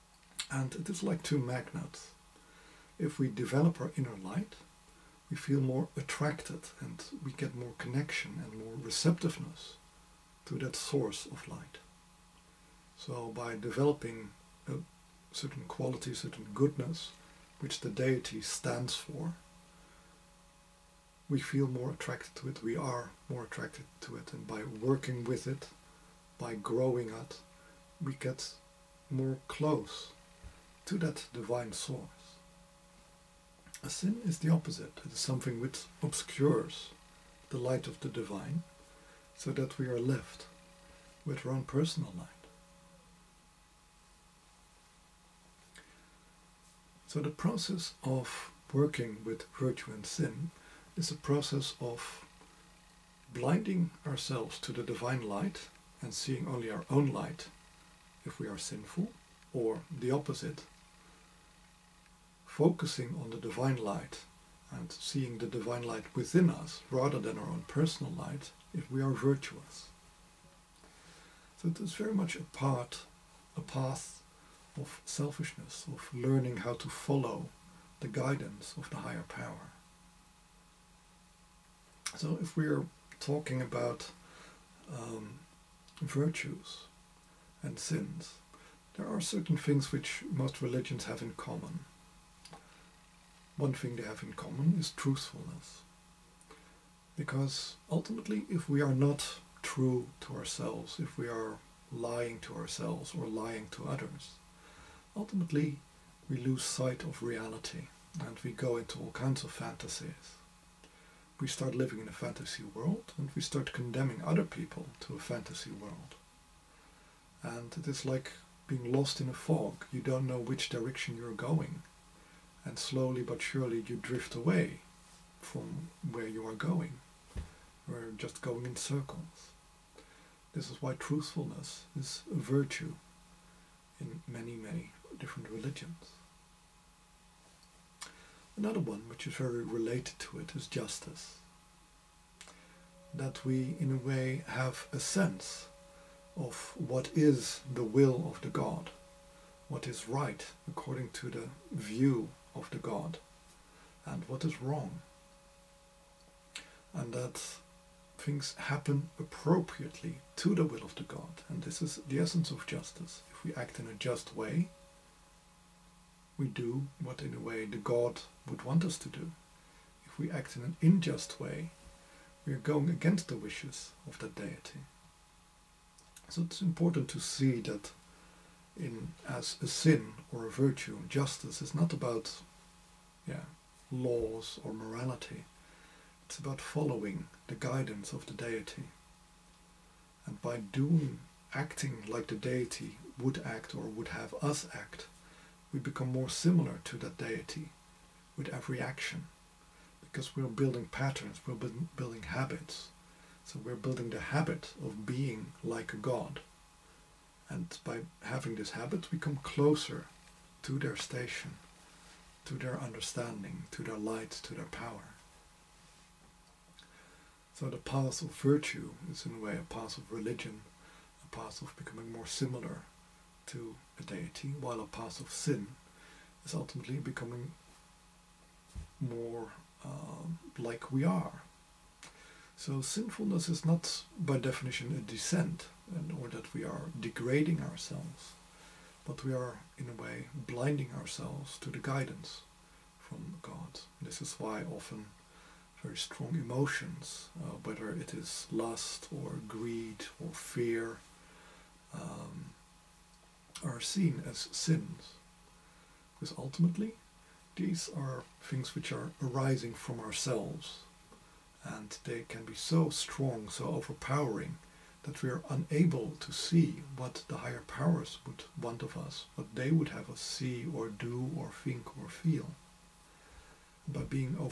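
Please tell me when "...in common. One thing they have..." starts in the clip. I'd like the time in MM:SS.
01:31.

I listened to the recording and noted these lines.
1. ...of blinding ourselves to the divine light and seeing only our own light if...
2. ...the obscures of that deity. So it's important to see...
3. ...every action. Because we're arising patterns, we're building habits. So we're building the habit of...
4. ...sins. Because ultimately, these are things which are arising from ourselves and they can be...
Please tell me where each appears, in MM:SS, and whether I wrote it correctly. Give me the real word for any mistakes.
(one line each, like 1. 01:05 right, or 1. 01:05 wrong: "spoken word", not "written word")
1. 00:51 right
2. 02:53 wrong: "wishes", not "obscures"
3. 03:18 wrong: "building", not "arising"
4. 04:14 right.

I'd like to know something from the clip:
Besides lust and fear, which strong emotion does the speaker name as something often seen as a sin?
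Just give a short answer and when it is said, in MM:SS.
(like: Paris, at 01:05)
Greed, at 04:09.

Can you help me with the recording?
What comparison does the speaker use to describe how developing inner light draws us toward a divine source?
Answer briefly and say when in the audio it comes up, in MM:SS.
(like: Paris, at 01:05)
Two magnets, at 00:01.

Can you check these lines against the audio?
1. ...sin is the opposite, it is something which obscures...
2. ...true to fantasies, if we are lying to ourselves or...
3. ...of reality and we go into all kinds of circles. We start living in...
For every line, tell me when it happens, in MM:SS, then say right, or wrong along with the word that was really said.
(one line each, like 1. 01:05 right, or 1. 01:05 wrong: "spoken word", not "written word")
1. 00:33 right
2. 01:39 wrong: "ourselves", not "fantasies"
3. 01:47 wrong: "fantasies", not "circles".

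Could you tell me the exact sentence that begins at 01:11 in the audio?
So it is very much a part, a path of selfishness, of learning how to follow the guidance of the higher power.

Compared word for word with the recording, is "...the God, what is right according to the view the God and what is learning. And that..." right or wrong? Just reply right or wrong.
wrong.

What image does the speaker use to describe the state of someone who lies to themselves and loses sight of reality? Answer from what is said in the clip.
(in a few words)
Lost in a fog.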